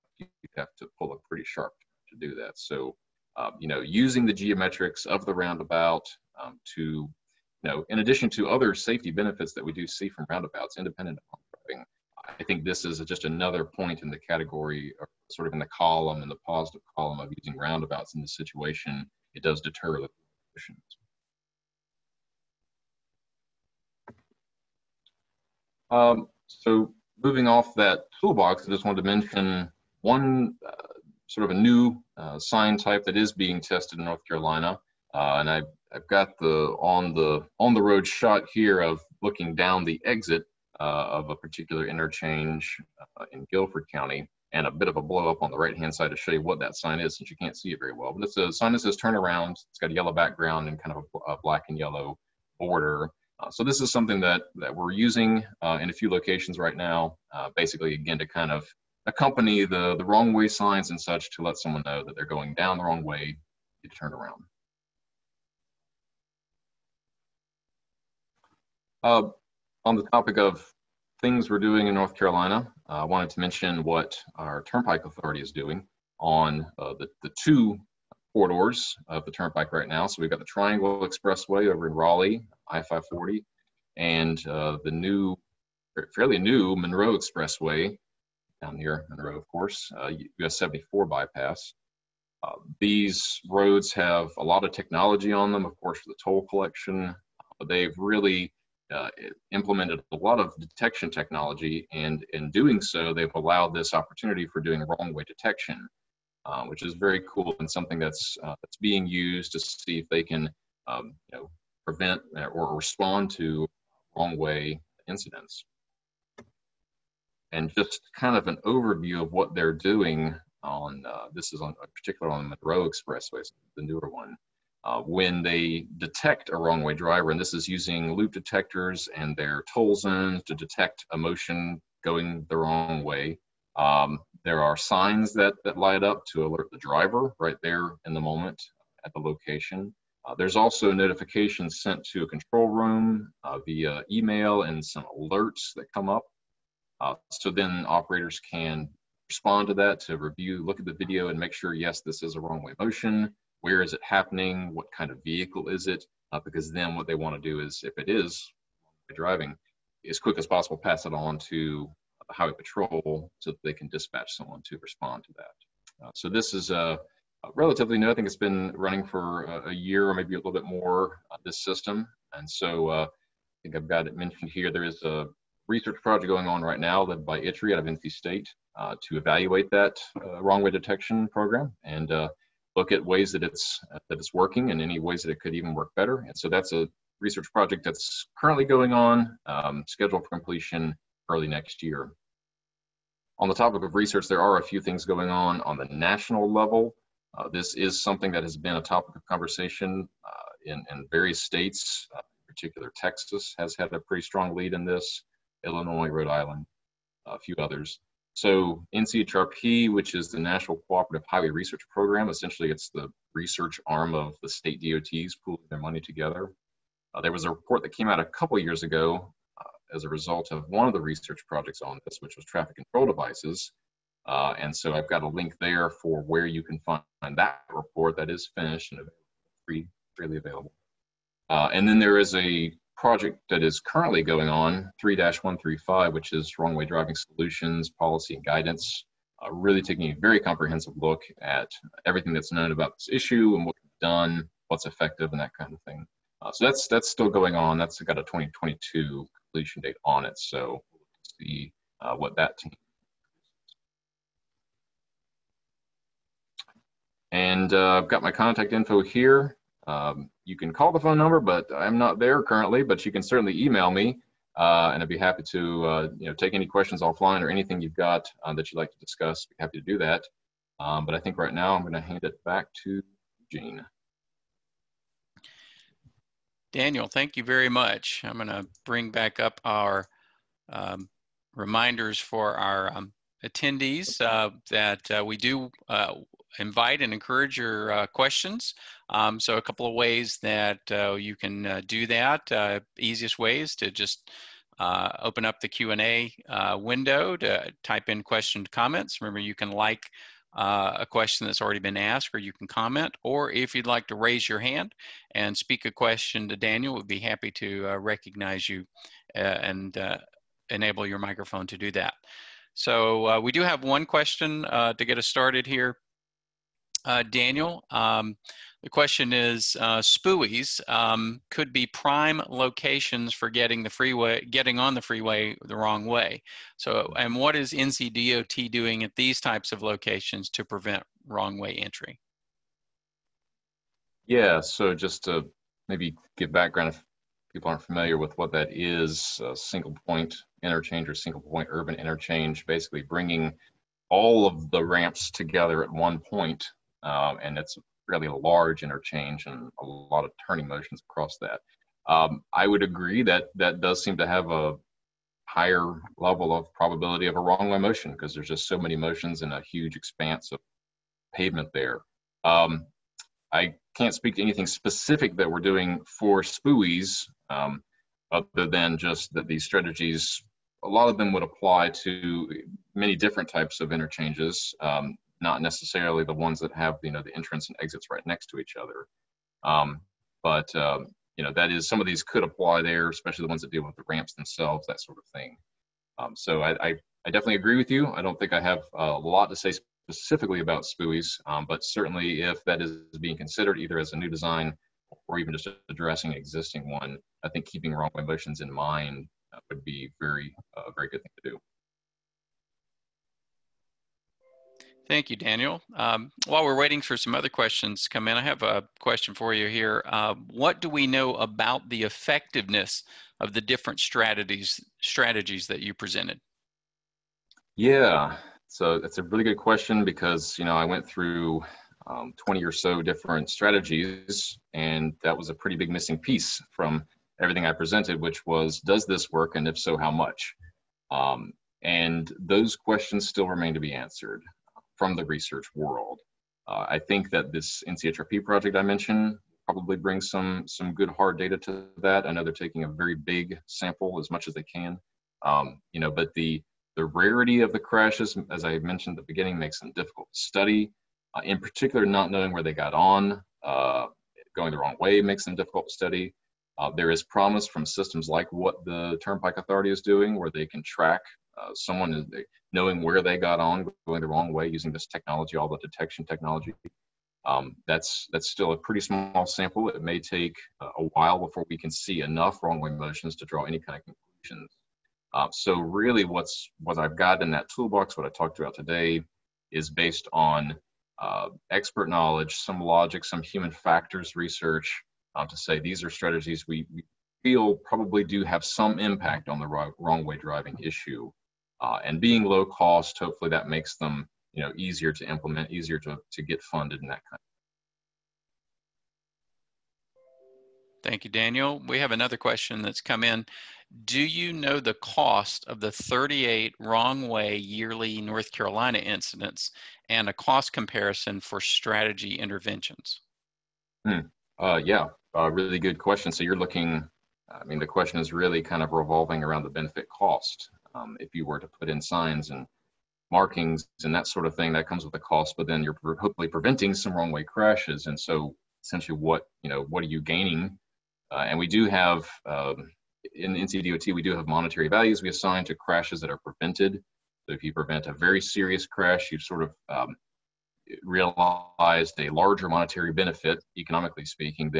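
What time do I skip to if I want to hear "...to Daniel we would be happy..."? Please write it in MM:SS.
05:06.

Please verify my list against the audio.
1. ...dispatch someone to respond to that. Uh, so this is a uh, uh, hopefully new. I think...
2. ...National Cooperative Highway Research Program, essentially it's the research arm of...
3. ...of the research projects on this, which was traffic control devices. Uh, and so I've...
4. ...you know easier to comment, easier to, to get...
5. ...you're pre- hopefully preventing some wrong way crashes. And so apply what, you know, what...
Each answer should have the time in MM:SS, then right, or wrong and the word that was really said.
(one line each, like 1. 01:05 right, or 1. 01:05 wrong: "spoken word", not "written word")
1. 02:43 wrong: "relatively", not "hopefully"
2. 03:30 right
3. 03:40 right
4. 08:14 wrong: "implement", not "comment"
5. 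08:45 wrong: "essentially", not "apply".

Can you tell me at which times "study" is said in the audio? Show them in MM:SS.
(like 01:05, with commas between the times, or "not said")
07:30, 07:35.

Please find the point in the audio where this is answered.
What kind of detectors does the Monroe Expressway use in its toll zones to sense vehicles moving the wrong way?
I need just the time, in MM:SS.
02:08.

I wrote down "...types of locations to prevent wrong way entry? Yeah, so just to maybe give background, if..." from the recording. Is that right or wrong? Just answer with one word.
right.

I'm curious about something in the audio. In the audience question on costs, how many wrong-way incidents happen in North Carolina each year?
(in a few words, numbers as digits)
38.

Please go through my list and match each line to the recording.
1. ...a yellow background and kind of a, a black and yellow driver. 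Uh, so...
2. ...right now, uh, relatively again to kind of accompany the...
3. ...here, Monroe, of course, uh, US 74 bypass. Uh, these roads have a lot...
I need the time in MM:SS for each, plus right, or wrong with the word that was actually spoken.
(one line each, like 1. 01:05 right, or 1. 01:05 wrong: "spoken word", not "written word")
1. 00:49 wrong: "border", not "driver"
2. 00:56 wrong: "basically", not "relatively"
3. 01:28 right.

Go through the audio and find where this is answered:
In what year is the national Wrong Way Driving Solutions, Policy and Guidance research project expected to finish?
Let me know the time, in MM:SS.
04:08.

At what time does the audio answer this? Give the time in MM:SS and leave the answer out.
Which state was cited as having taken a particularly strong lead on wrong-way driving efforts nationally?
03:22.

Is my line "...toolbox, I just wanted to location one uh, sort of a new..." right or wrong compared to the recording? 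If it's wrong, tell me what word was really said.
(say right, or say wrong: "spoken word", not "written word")
wrong: "mention", not "location".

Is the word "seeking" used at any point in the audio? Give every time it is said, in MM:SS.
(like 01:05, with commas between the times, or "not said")
not said.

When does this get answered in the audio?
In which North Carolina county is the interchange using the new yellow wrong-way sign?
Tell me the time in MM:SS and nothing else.
00:43.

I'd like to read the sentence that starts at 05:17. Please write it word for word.
Um, the question is, uh, um, could be prime locations for getting the freeway, getting on the freeway the wrong way.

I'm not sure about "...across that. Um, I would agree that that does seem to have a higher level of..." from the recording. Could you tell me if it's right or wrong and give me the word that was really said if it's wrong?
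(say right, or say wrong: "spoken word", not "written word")
right.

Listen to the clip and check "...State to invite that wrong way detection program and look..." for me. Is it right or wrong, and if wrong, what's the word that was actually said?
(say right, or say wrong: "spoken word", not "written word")
wrong: "evaluate", not "invite".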